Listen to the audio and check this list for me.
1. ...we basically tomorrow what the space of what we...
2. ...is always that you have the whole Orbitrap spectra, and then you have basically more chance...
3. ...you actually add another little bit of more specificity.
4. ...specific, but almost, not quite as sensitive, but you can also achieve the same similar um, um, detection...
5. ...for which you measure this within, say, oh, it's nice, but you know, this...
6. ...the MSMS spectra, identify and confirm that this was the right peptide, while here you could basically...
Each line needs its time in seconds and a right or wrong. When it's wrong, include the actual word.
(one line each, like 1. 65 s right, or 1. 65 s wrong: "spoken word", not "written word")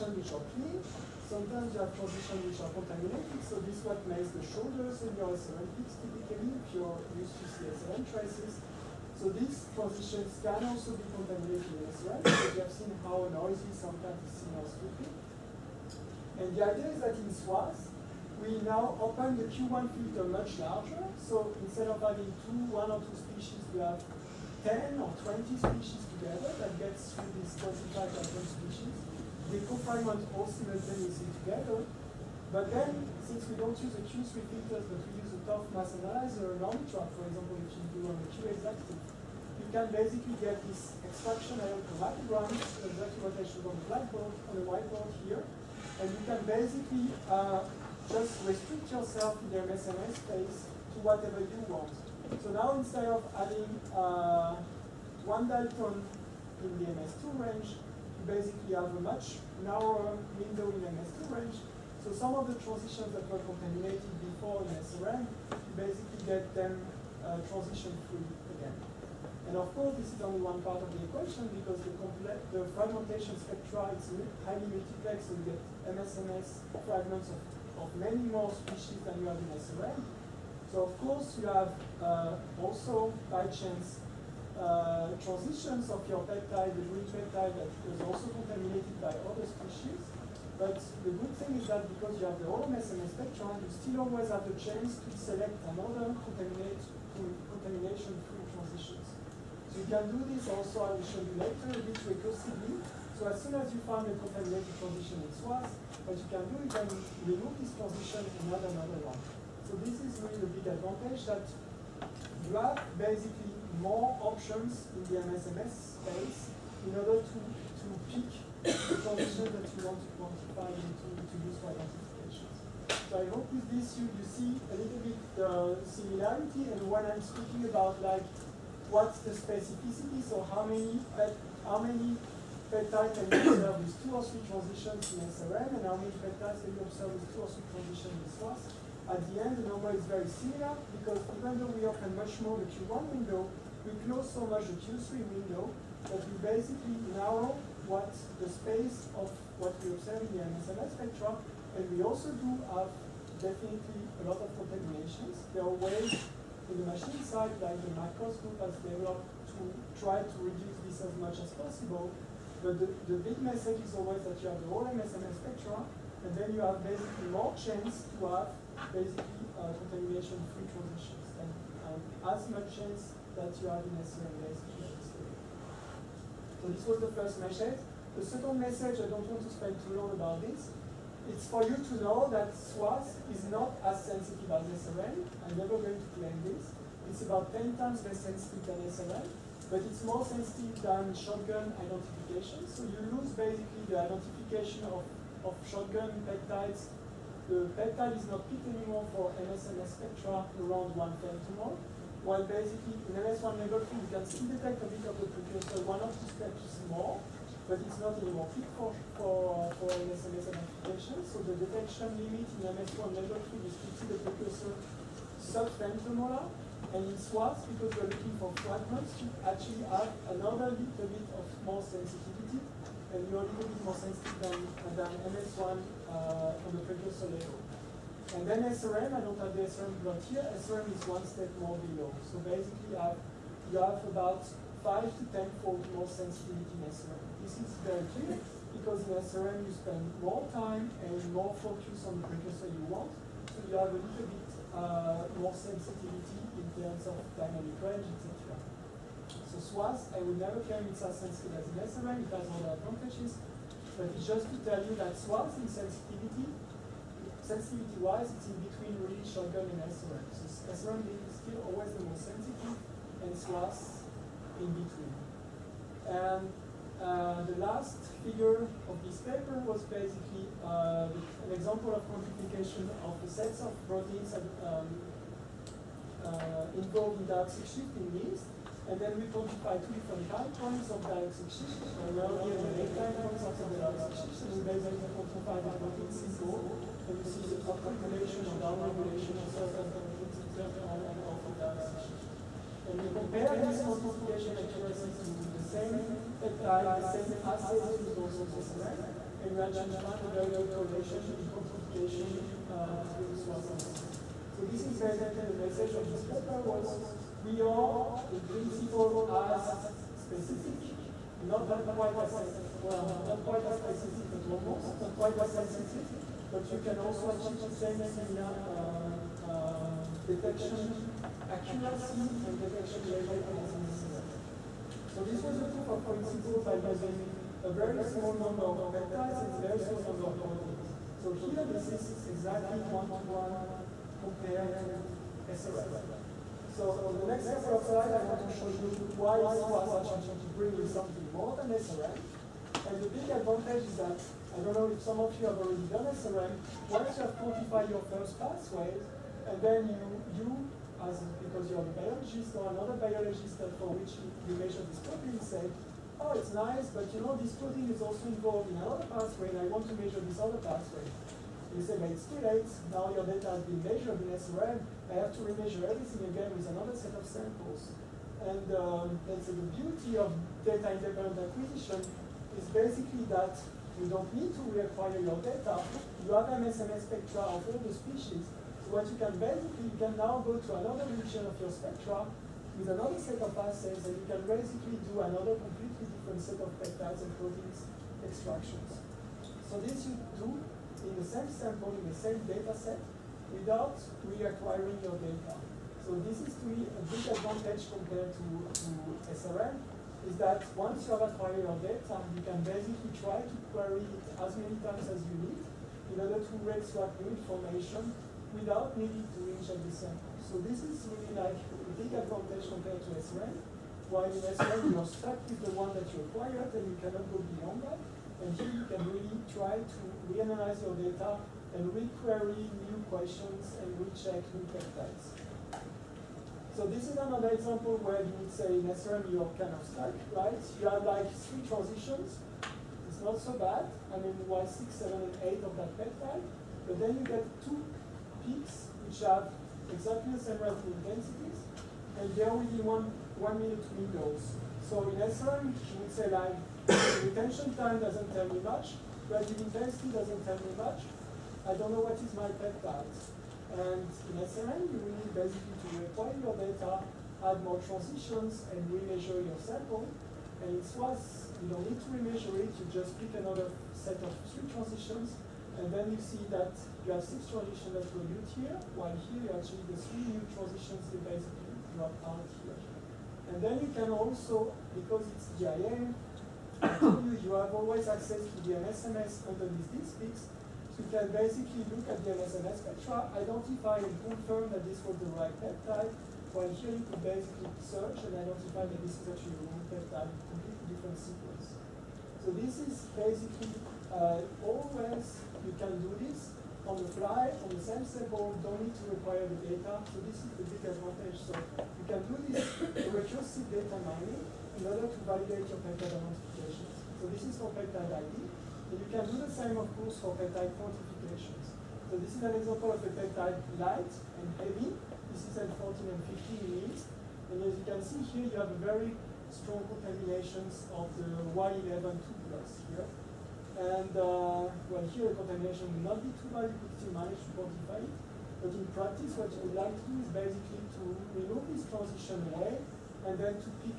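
1. 146 s wrong: "narrow", not "tomorrow"
2. 163 s wrong: "MSMS", not "Orbitrap"
3. 219 s wrong: "sensitivity", not "specificity"
4. 313 s right
5. 353 s wrong: "protein", not "within"
6. 482 s right.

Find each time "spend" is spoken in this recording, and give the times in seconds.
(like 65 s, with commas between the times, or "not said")
179 s, 239 s.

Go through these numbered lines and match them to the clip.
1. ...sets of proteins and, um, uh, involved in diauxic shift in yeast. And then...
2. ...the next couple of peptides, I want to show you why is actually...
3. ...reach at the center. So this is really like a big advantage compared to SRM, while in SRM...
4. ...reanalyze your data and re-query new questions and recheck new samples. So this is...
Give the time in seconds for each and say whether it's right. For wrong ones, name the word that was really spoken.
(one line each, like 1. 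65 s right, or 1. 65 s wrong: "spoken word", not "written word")
1. 273 s right
2. 337 s wrong: "slides", not "peptides"
3. 409 s right
4. 420 s wrong: "peptides", not "samples".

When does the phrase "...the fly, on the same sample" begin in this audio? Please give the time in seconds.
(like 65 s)
497 s.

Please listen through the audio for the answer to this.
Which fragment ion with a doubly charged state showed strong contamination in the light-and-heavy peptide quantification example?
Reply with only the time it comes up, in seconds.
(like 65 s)
521 s.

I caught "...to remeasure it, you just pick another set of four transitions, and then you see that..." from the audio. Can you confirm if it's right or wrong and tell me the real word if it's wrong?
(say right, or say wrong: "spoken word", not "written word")
wrong: "three", not "four".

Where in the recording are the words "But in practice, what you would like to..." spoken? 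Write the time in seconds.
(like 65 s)
528 s.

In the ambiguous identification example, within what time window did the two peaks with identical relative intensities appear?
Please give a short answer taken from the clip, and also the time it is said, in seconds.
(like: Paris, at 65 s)
One minute, at 443 s.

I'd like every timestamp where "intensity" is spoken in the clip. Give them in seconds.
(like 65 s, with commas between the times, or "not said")
449 s.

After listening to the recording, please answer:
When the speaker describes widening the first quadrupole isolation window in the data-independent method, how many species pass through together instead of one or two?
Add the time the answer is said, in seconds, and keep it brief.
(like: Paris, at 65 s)
10 or 20, at 24 s.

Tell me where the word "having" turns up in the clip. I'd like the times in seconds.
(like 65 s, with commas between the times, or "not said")
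22 s.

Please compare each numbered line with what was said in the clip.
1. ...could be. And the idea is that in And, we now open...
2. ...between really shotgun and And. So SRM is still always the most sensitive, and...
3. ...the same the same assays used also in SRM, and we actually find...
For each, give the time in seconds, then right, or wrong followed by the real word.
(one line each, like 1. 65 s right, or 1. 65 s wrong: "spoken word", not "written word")
1. 14 s wrong: "SWATH", not "And"
2. 258 s wrong: "SRM", not "And"
3. 295 s right.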